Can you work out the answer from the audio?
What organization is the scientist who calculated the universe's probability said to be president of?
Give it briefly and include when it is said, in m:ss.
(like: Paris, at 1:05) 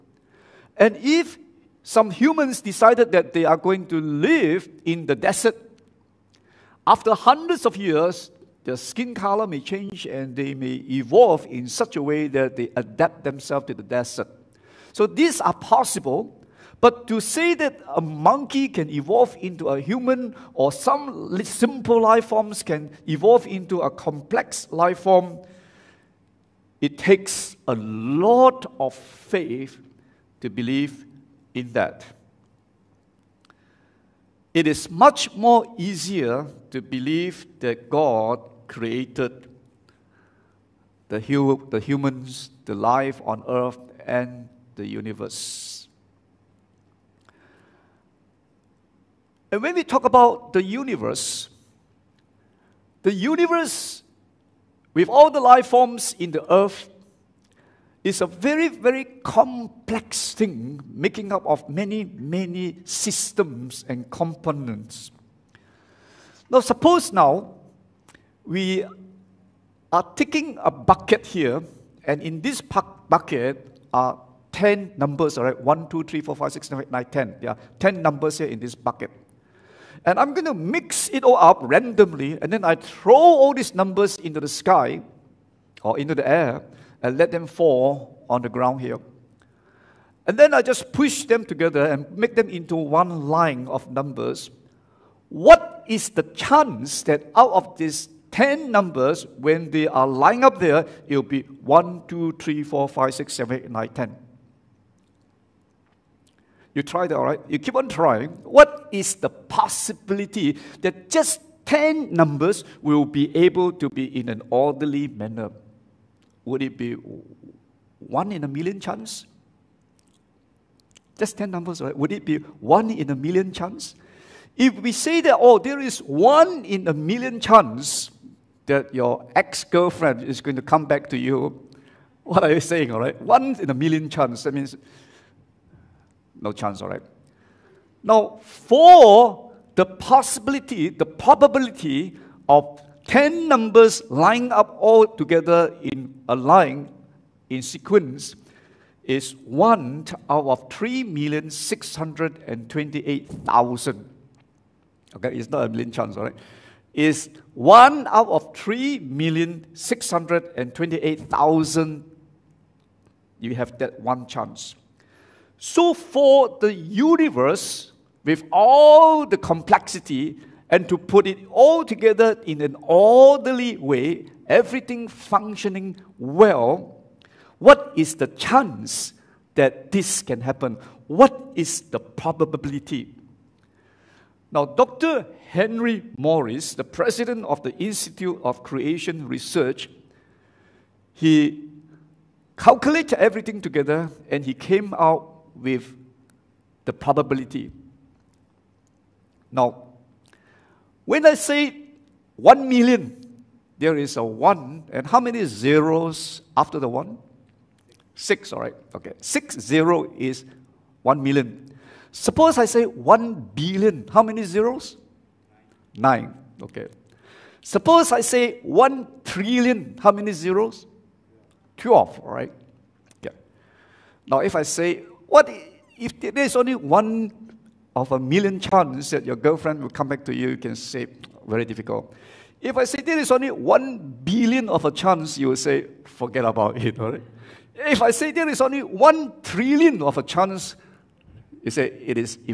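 Institute of Creation Research, at 3:07.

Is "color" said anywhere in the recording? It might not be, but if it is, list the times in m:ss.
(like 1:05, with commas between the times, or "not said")
0:09.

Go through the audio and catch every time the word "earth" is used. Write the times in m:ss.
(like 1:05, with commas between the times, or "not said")
0:43, 0:56.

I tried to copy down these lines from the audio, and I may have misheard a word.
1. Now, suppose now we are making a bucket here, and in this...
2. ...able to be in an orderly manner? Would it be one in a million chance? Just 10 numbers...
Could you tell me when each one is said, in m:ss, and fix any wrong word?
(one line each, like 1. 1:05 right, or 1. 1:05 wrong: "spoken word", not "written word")
1. 1:06 wrong: "taking", not "making"
2. 1:53 right.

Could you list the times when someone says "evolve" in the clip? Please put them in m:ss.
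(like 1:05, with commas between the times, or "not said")
0:10, 0:18, 0:23.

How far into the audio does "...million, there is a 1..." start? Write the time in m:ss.
3:22.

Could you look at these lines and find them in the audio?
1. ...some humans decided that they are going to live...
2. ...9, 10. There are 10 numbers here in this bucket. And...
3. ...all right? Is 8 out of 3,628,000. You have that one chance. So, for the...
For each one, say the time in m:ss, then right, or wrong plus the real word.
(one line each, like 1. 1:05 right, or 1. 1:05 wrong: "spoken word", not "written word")
1. 0:01 right
2. 1:16 right
3. 2:36 wrong: "1", not "8".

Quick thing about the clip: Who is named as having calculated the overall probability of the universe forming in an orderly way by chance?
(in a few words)
Henry Morris.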